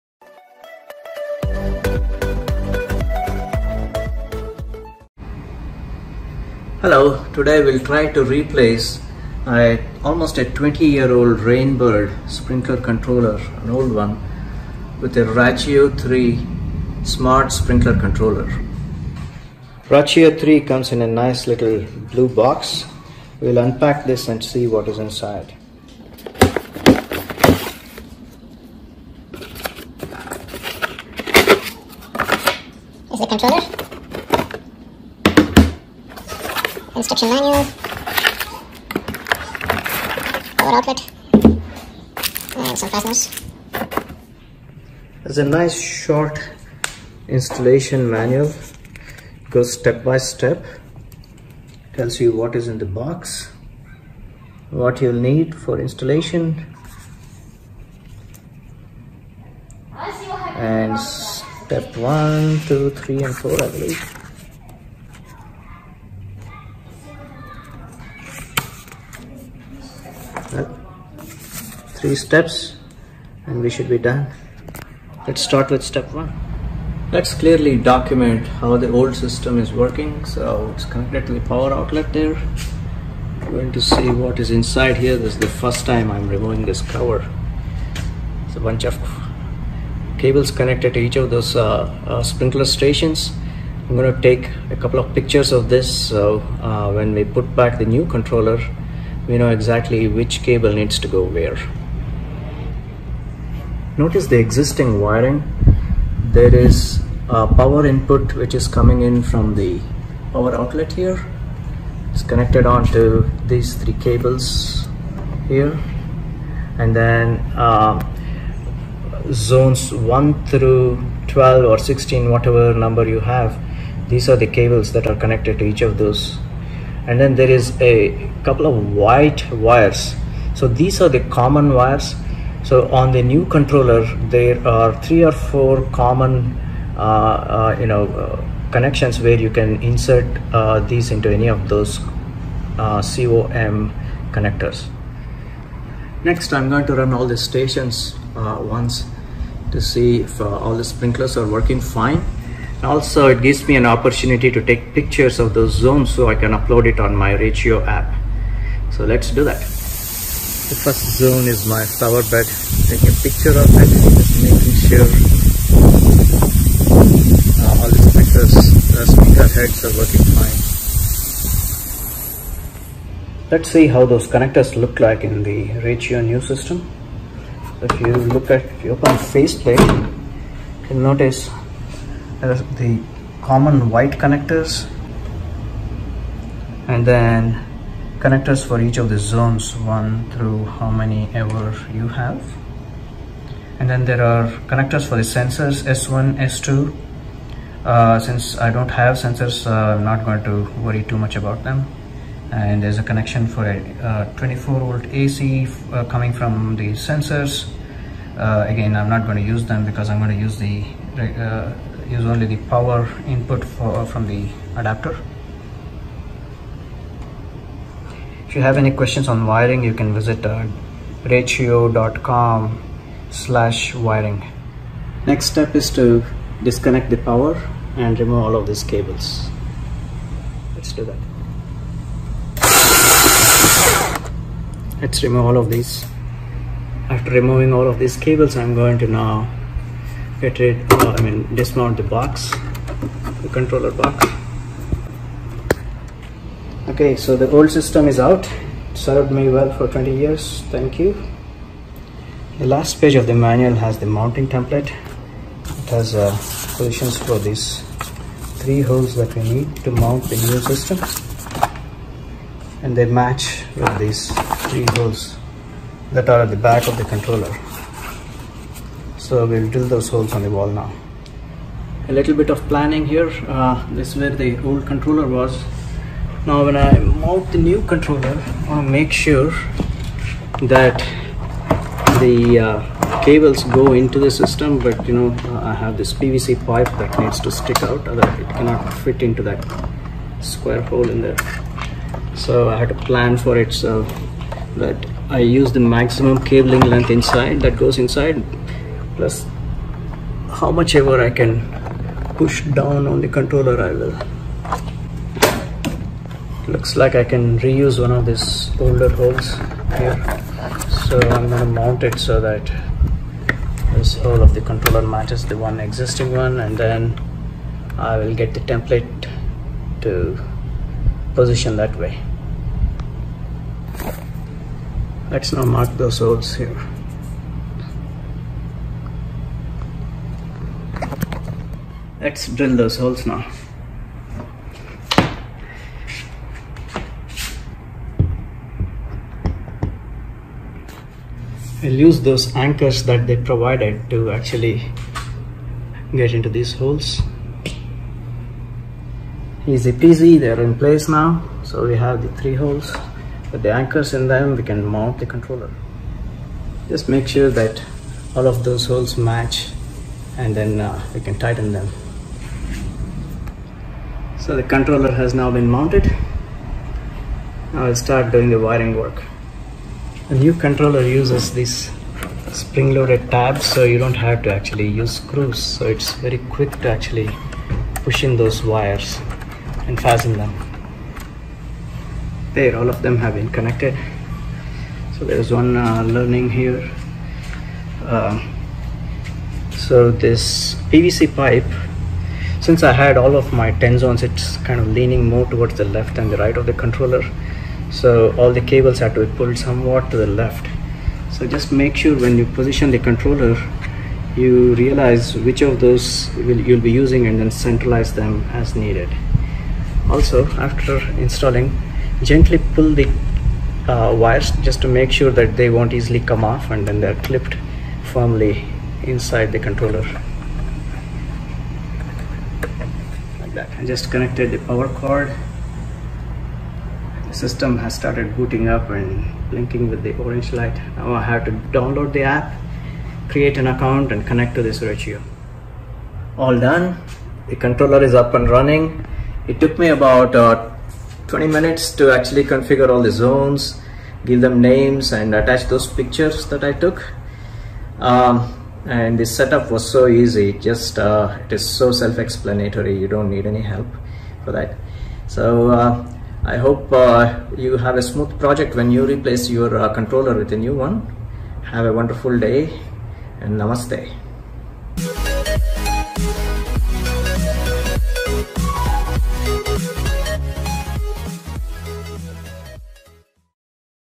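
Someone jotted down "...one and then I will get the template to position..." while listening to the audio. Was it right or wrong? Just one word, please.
right.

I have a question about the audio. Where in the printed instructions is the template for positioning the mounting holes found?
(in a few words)
last page.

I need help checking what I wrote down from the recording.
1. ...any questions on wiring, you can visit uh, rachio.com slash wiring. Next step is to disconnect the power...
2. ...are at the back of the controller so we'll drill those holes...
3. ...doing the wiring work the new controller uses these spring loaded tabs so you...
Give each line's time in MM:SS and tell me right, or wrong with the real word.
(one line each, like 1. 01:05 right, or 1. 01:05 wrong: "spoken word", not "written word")
1. 03:38 right
2. 04:26 right
3. 06:08 right.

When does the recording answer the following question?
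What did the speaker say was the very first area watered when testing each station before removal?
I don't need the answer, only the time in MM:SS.
02:41.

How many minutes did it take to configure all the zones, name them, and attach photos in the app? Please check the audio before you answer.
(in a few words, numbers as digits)
20.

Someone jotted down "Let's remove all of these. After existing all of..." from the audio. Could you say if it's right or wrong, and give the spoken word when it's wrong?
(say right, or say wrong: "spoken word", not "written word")
wrong: "removing", not "existing".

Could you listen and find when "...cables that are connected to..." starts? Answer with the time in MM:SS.
02:04.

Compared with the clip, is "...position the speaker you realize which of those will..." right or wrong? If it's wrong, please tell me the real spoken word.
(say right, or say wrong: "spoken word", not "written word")
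wrong: "controller", not "speaker".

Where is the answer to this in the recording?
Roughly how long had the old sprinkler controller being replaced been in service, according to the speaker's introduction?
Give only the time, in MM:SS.
00:10.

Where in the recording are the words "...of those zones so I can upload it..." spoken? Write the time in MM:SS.
02:35.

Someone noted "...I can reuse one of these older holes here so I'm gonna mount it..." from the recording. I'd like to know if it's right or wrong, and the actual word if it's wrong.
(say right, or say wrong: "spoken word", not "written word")
right.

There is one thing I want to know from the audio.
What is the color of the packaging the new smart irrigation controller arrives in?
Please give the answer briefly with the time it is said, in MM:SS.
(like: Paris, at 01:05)
blue, at 00:22.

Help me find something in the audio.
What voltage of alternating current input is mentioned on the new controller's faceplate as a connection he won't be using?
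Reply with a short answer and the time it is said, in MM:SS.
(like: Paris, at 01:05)
24 volt, at 03:24.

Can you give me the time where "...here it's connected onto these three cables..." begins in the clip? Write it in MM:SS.
01:50.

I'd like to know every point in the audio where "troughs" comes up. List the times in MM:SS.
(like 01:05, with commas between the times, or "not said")
not said.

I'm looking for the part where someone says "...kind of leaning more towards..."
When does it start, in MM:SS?
06:34.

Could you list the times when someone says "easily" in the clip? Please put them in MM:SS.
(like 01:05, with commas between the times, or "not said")
06:55.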